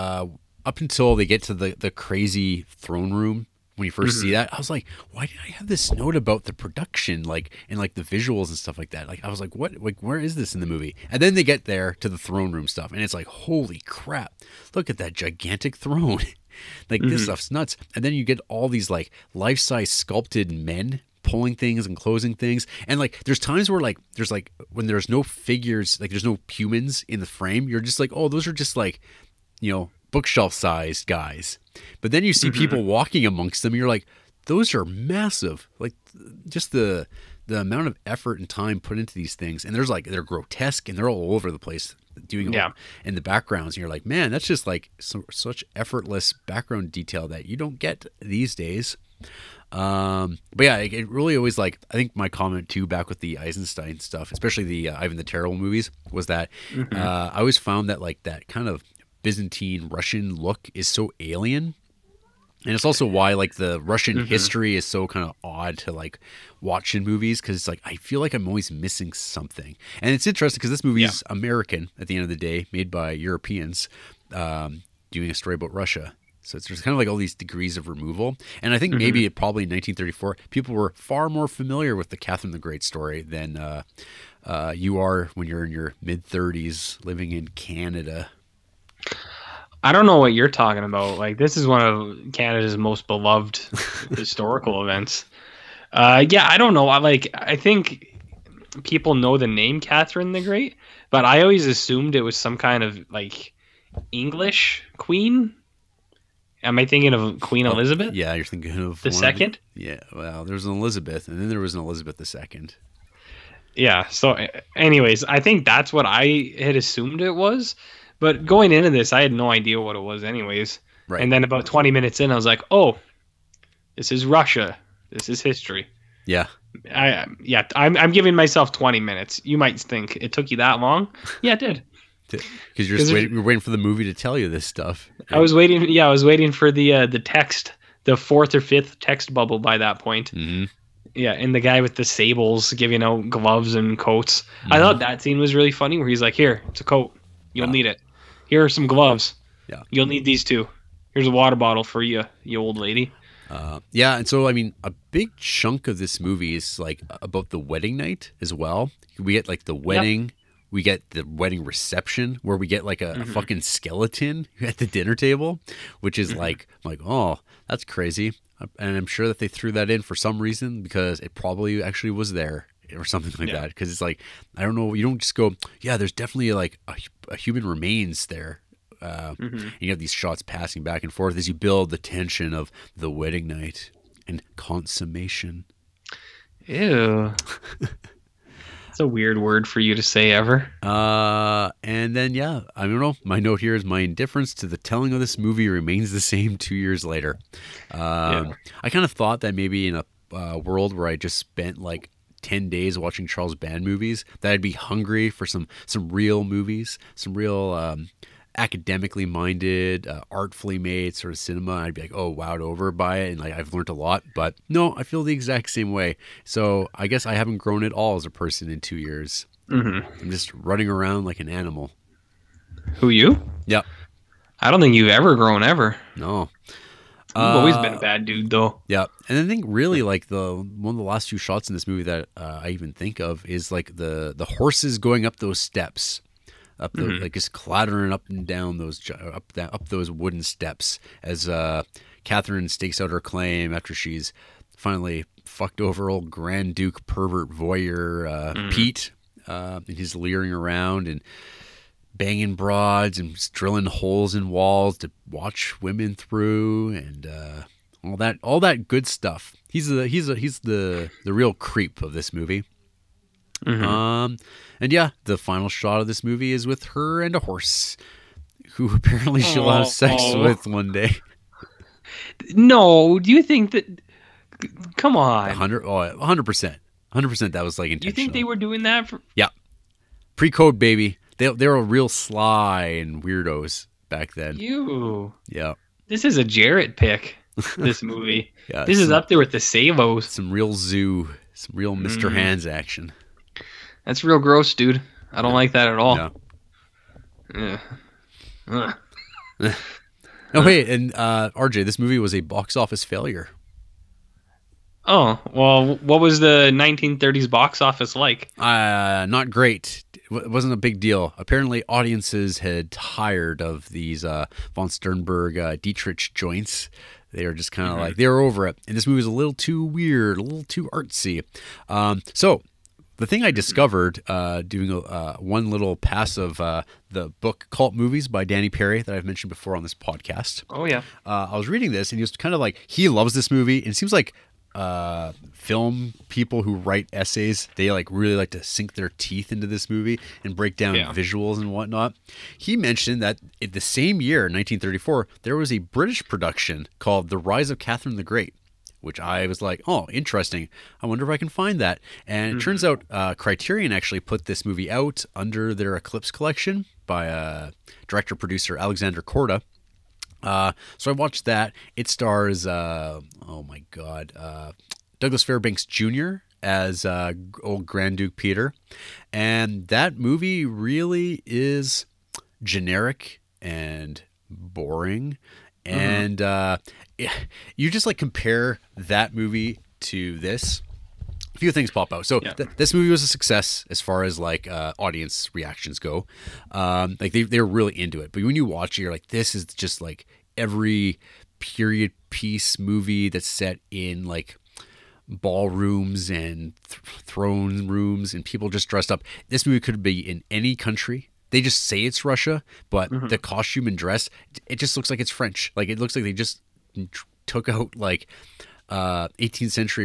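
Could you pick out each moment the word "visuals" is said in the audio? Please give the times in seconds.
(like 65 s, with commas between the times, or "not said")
8 s, 341 s.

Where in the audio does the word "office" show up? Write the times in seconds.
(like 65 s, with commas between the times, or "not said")
302 s, 307 s.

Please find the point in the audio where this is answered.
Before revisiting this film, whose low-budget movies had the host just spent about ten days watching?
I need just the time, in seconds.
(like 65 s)
203 s.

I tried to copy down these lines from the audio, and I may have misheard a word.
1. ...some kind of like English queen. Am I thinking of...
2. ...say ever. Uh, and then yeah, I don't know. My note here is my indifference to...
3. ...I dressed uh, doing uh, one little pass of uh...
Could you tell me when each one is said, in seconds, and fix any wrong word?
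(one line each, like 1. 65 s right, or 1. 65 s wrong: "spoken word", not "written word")
1. 102 s right
2. 190 s right
3. 323 s wrong: "discovered", not "dressed".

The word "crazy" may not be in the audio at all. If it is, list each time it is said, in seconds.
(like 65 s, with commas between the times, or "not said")
1 s, 167 s.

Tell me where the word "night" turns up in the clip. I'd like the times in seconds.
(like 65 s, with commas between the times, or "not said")
157 s, 183 s.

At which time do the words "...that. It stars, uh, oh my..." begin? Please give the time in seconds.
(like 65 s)
361 s.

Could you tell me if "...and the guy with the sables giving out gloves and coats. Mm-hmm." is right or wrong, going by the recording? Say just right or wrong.
right.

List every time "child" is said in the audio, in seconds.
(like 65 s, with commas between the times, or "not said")
not said.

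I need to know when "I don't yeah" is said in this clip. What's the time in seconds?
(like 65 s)
295 s.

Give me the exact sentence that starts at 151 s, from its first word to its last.
Here's a water bottle for you, you old lady.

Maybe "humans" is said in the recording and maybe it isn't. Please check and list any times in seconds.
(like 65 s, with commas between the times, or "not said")
26 s, 177 s.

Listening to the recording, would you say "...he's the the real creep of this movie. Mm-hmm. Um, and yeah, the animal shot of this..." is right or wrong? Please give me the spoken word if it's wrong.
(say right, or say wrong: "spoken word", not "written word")
wrong: "final", not "animal".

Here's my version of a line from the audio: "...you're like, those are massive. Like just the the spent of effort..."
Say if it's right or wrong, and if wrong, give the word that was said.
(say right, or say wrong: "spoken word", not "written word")
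wrong: "amount", not "spent".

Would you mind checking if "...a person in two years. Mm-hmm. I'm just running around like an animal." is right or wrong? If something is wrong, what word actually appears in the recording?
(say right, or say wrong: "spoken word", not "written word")
right.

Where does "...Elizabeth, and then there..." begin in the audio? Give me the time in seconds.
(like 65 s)
110 s.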